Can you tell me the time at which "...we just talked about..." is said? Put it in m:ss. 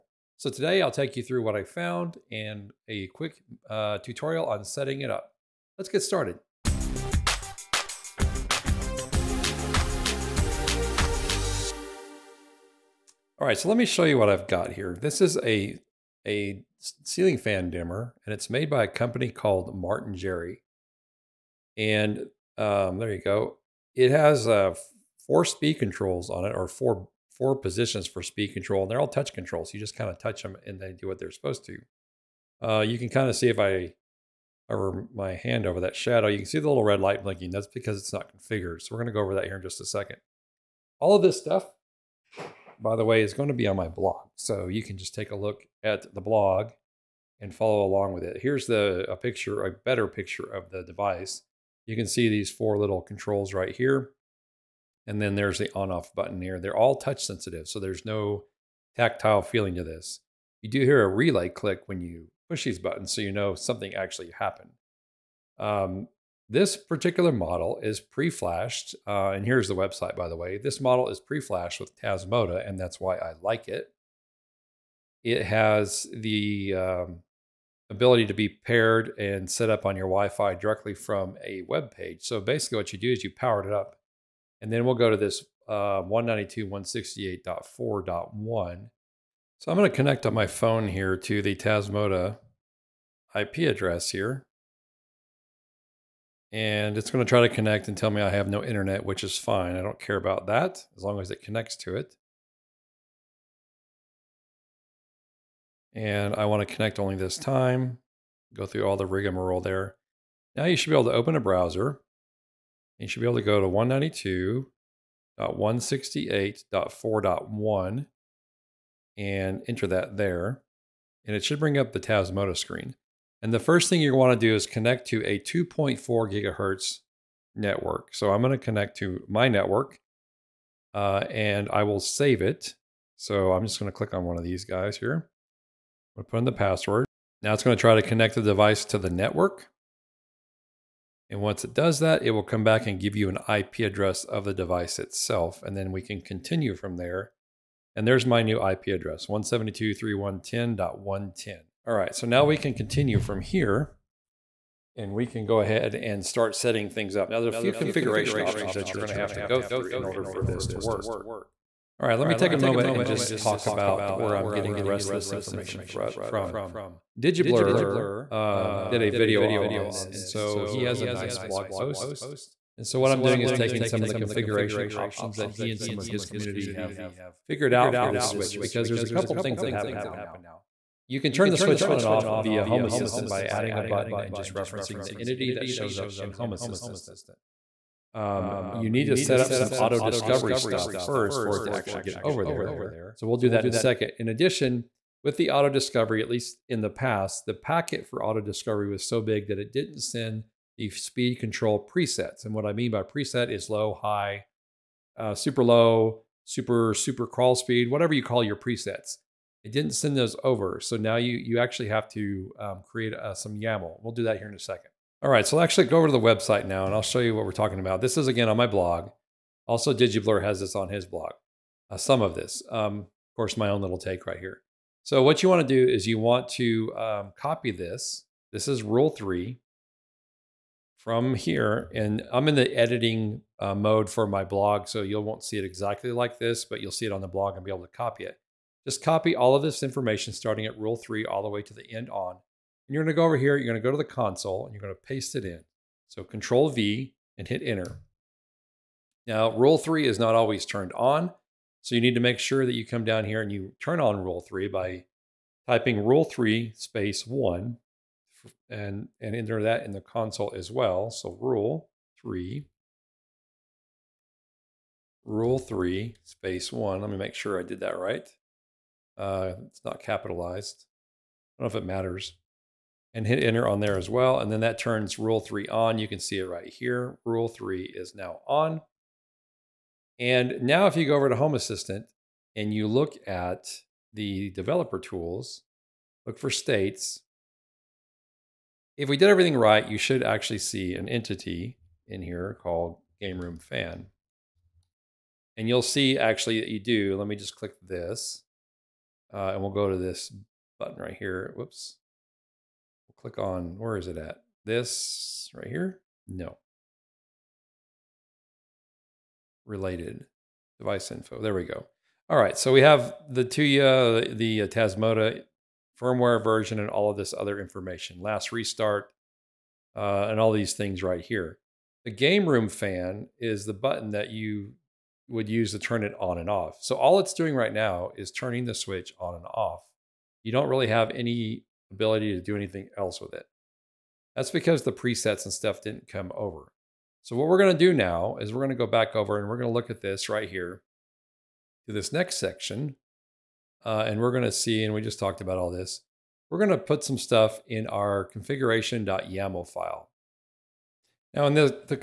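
5:44.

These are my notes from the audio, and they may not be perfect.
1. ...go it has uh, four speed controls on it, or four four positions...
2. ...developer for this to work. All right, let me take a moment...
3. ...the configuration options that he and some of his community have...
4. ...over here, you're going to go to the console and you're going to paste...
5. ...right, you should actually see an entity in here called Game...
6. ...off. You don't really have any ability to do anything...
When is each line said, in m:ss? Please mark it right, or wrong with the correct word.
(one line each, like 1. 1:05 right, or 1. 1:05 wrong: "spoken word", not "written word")
1. 0:23 right
2. 2:40 wrong: "order", not "developer"
3. 2:54 right
4. 4:03 right
5. 4:49 right
6. 5:29 right.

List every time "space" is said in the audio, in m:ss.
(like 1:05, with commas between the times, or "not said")
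4:16, 4:26.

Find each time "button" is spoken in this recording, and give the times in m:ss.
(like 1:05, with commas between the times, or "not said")
0:56, 1:02, 3:03, 5:00, 5:23.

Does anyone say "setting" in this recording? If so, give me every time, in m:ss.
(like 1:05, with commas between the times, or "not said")
0:04, 2:36.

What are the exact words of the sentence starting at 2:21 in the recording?
And once it does that, it will come back and give you an IP address of the device itself.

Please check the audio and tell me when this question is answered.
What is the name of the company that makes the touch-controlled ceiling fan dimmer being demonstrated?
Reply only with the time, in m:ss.
0:19.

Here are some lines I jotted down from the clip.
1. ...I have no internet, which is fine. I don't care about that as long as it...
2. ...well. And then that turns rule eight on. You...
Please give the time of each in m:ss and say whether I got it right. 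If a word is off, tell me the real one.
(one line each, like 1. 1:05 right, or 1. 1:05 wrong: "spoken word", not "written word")
1. 1:38 right
2. 4:34 wrong: "three", not "eight".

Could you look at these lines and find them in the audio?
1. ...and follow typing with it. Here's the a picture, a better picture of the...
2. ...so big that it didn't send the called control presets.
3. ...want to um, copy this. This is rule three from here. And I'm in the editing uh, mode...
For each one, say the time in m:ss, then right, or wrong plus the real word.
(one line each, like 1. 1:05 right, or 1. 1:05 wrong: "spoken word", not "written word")
1. 0:47 wrong: "along", not "typing"
2. 3:19 wrong: "speed", not "called"
3. 3:46 right.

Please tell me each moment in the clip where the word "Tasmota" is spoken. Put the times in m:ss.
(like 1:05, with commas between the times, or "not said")
1:12, 1:31, 2:02, 5:14.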